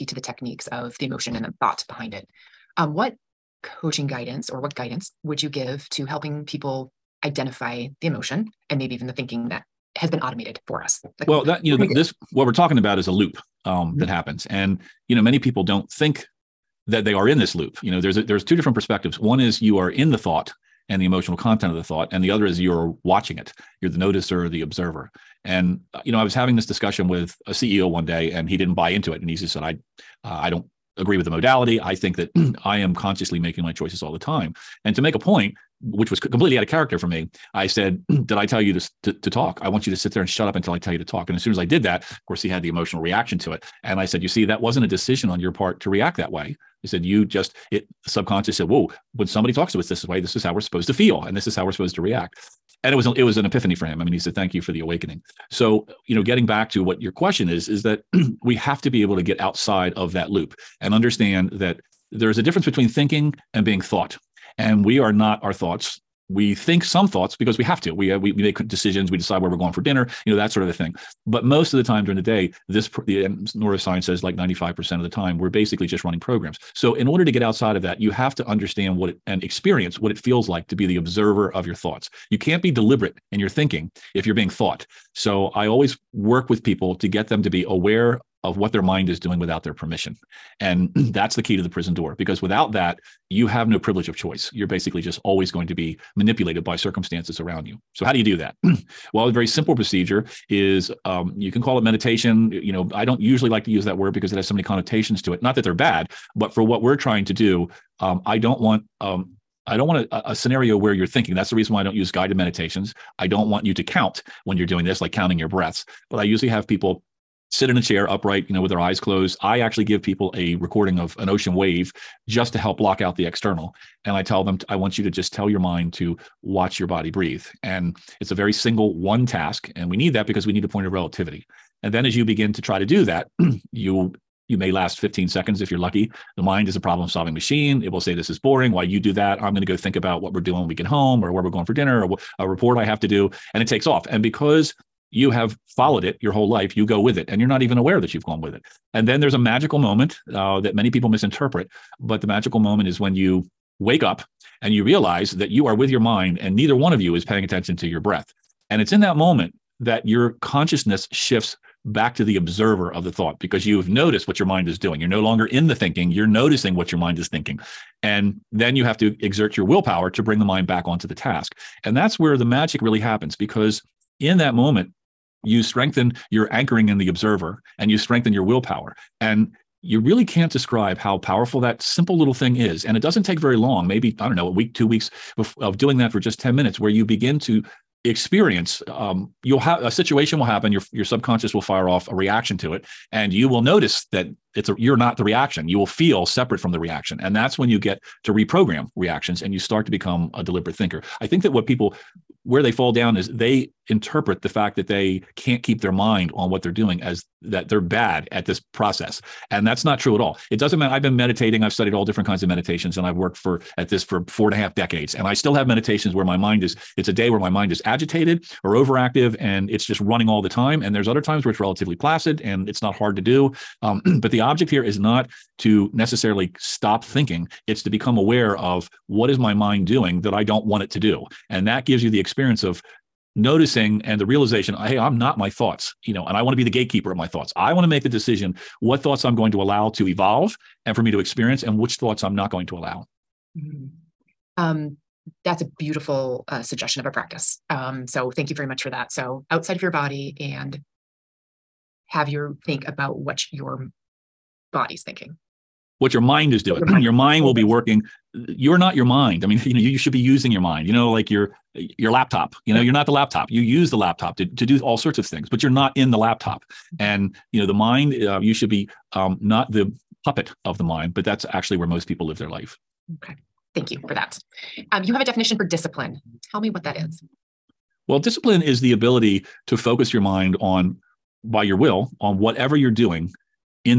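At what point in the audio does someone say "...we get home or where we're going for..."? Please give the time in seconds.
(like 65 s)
140 s.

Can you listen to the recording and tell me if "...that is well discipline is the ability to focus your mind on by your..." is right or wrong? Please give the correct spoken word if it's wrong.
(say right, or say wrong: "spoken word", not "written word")
right.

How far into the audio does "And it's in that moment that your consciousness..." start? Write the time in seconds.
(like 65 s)
158 s.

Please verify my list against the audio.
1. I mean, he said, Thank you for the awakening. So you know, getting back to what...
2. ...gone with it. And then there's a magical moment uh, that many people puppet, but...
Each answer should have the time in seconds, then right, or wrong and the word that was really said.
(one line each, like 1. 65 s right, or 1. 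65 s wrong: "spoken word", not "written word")
1. 54 s right
2. 148 s wrong: "misinterpret", not "puppet".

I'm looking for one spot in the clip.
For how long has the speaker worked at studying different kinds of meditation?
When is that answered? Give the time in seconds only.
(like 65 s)
214 s.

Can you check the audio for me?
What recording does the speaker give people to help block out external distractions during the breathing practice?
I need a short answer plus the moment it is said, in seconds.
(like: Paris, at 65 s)
an ocean wave, at 121 s.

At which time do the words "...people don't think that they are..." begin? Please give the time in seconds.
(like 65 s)
15 s.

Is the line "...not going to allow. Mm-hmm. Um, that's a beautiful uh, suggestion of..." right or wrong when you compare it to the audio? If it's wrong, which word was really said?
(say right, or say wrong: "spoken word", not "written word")
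right.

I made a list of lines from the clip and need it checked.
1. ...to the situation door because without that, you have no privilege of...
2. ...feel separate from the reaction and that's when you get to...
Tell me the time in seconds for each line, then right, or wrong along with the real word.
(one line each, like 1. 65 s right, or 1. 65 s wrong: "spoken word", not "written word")
1. 91 s wrong: "prison", not "situation"
2. 195 s right.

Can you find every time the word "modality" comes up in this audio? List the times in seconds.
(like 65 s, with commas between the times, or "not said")
31 s.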